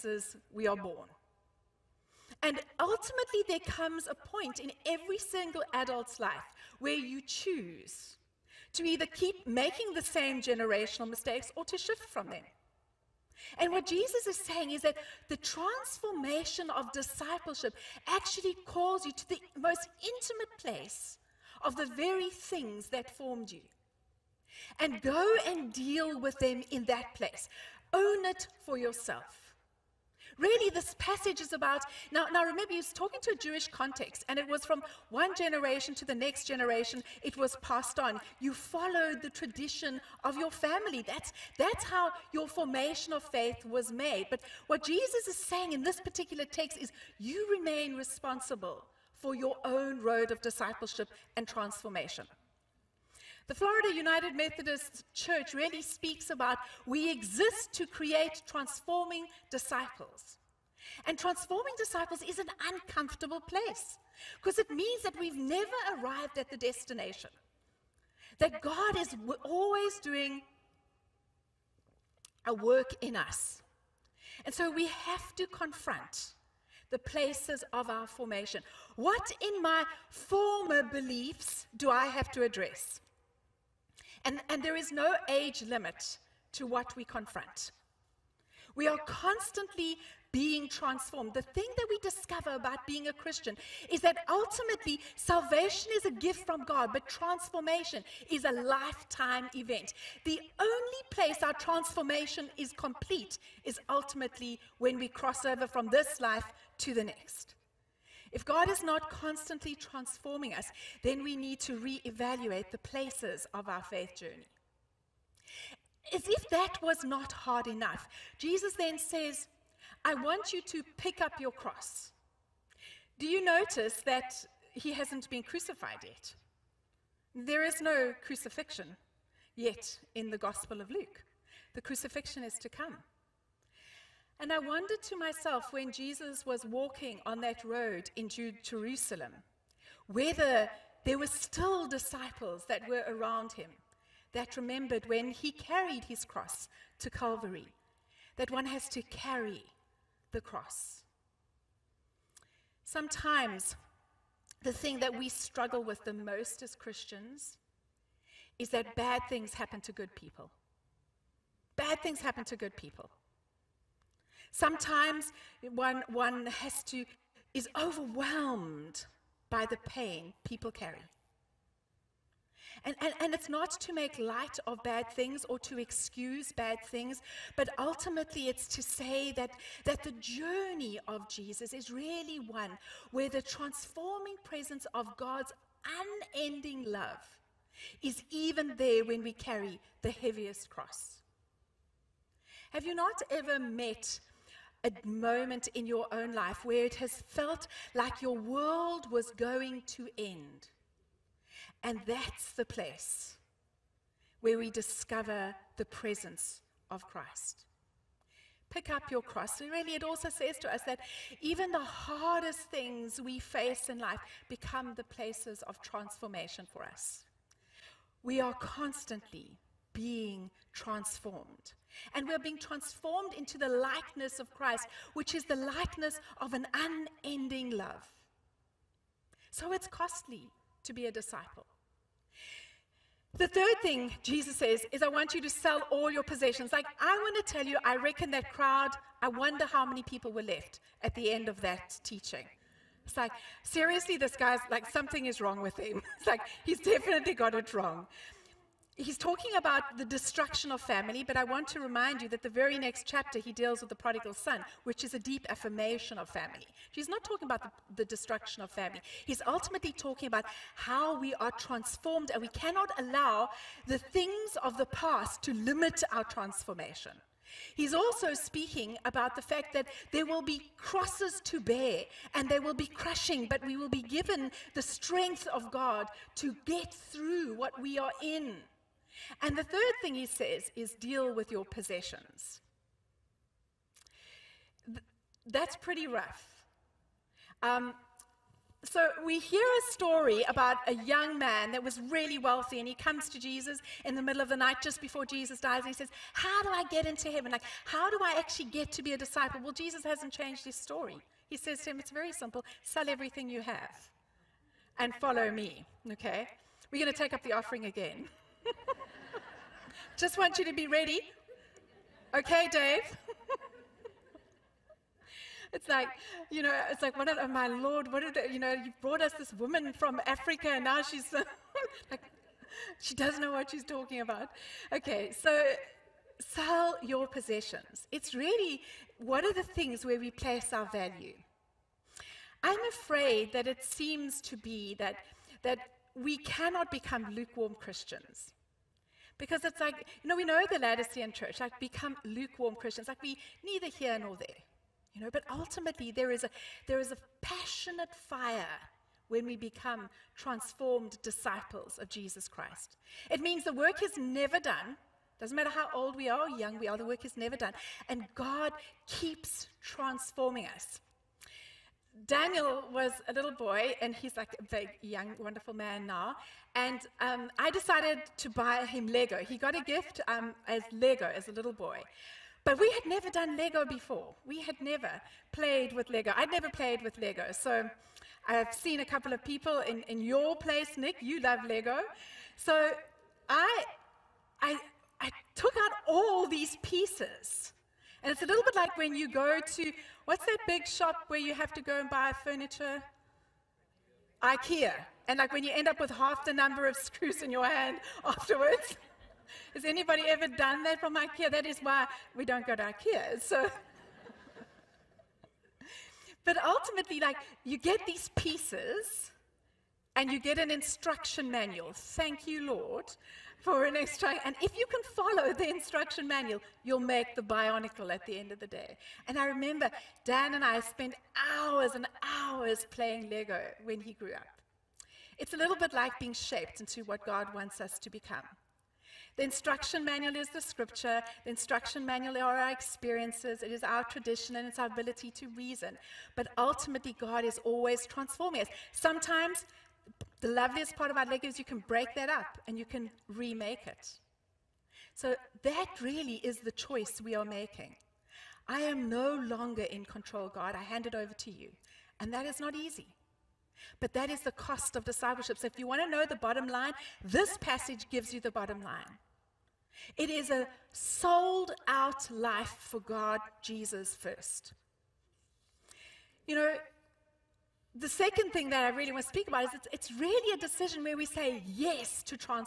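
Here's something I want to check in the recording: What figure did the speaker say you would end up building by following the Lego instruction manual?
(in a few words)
Bionicle.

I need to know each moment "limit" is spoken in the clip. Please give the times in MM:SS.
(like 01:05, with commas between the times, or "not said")
01:25, 04:25.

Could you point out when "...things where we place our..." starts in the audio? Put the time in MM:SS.
05:29.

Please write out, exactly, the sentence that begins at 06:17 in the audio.
So I've seen a couple of people in, in your place, Nick.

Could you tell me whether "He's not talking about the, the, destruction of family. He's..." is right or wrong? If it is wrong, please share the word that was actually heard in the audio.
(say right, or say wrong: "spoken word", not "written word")
right.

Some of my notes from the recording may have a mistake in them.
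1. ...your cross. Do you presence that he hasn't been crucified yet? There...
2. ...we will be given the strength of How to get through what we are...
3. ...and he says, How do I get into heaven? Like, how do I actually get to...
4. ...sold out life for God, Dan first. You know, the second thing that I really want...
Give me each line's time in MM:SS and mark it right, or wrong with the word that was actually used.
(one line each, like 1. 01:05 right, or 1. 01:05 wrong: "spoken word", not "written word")
1. 02:01 wrong: "notice", not "presence"
2. 04:33 wrong: "God", not "How"
3. 04:55 right
4. 07:40 wrong: "Jesus", not "Dan".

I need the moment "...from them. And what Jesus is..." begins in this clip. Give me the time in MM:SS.
00:12.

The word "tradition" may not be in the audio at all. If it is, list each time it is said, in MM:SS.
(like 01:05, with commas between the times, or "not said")
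00:39, 07:14.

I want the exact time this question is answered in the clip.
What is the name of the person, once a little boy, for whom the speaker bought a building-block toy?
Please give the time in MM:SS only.
06:02.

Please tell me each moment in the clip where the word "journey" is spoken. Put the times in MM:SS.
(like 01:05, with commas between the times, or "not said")
01:54, 03:00.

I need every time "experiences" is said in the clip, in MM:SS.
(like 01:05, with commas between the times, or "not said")
07:12.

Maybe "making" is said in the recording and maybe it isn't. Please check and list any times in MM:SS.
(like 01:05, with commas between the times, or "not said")
00:09, 07:27.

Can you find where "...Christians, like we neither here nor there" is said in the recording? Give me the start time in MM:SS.
05:42.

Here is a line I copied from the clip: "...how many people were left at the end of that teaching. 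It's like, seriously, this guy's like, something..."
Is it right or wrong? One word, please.
right.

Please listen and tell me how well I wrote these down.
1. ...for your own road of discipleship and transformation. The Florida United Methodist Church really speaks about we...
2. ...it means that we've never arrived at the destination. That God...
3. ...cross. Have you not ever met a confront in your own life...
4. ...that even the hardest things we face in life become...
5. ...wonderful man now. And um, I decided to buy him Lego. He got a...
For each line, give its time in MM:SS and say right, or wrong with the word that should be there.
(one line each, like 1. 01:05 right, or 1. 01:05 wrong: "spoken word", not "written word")
1. 00:49 right
2. 01:04 right
3. 03:10 wrong: "moment", not "confront"
4. 03:30 right
5. 06:05 right.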